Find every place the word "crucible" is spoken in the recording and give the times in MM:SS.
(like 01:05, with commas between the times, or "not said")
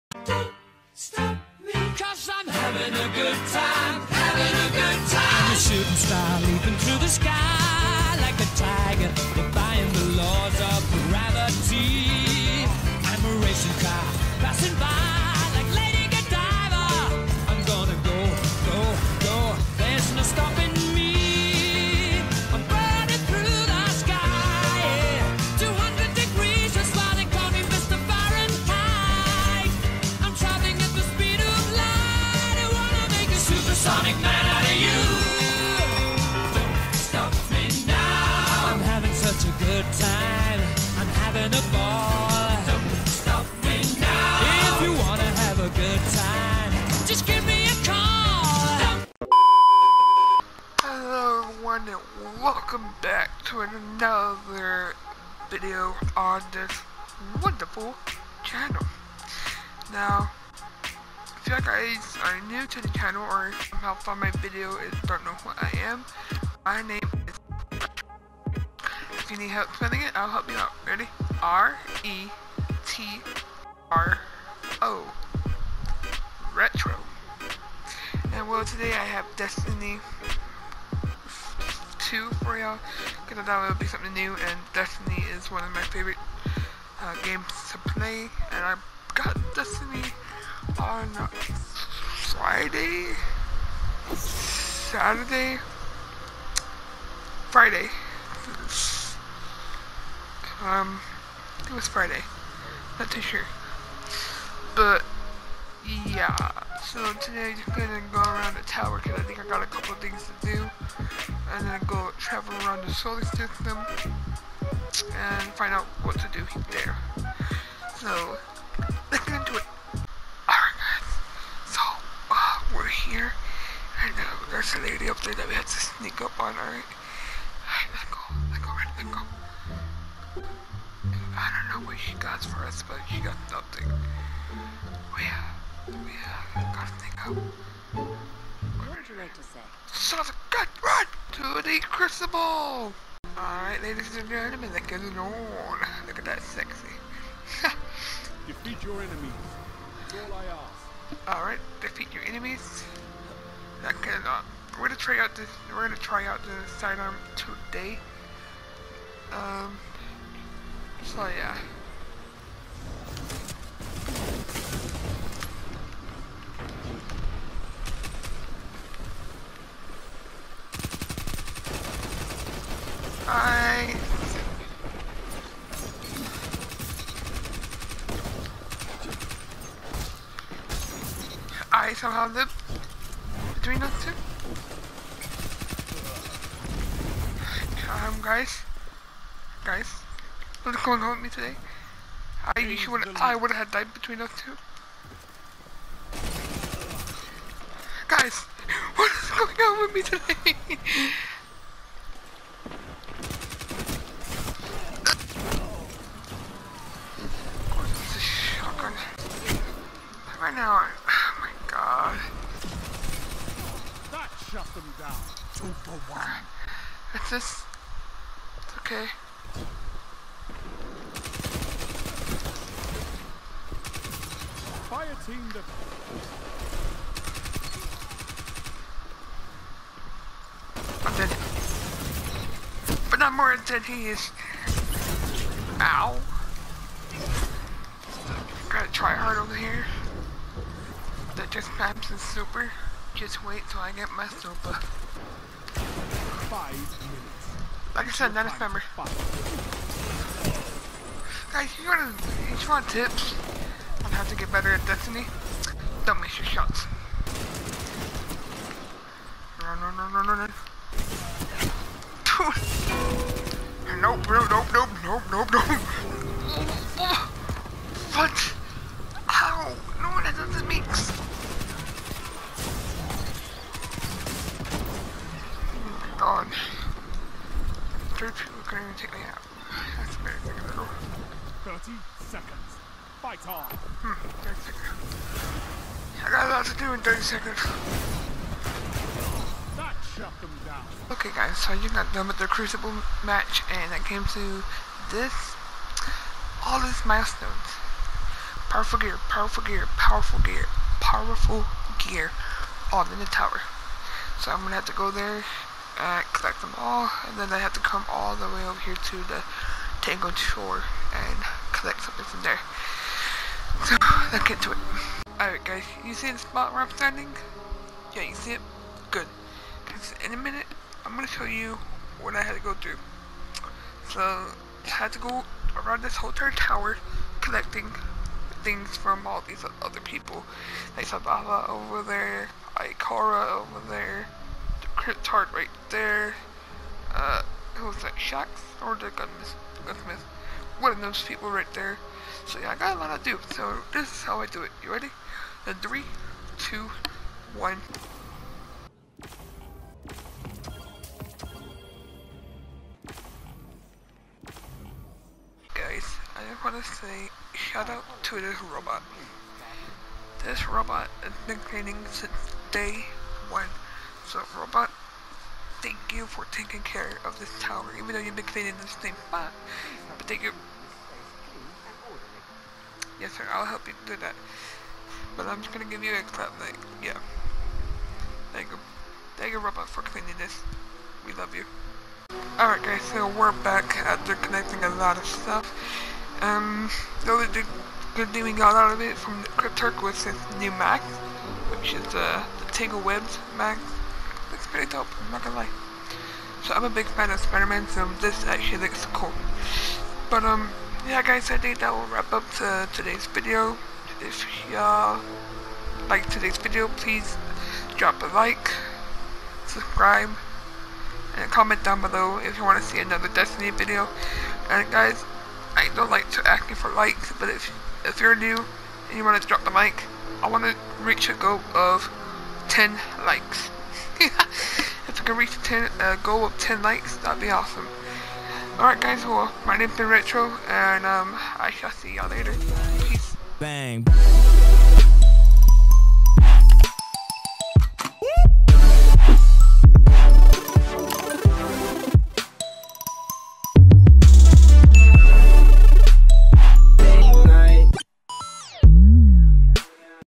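02:21, 04:52.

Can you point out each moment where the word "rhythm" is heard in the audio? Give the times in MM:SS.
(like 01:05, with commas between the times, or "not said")
not said.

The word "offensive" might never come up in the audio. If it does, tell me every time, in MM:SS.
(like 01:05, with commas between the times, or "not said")
not said.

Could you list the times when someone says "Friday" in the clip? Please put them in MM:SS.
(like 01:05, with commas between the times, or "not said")
01:32, 01:37, 01:41.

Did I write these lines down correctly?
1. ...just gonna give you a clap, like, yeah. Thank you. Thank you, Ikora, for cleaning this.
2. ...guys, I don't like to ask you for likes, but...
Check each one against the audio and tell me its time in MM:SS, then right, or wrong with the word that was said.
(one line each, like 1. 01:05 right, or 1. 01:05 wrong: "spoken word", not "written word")
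1. 06:15 wrong: "Robot", not "Ikora"
2. 06:54 right.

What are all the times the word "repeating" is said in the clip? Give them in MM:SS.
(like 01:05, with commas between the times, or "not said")
not said.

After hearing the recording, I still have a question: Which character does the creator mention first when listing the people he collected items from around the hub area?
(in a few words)
Zavala.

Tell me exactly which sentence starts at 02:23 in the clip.
Alright, ladies and gentlemen, that goes on.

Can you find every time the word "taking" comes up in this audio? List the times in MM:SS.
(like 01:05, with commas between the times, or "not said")
06:06.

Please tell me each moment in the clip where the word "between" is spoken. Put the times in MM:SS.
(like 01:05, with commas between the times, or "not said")
03:03, 03:13.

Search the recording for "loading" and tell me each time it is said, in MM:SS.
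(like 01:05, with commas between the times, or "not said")
not said.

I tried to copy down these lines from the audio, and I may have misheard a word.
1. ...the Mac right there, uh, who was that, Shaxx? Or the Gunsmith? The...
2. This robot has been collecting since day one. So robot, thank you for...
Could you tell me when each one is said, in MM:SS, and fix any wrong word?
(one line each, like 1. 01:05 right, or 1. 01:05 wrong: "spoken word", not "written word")
1. 05:34 wrong: "Cryptarch", not "Mac"
2. 06:00 wrong: "cleaning", not "collecting".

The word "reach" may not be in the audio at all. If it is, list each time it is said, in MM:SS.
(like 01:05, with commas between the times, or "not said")
07:01, 07:05.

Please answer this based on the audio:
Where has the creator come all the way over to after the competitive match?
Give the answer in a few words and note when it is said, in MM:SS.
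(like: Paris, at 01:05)
Tangled Shore, at 05:10.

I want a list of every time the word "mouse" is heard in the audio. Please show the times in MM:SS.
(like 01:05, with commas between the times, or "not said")
not said.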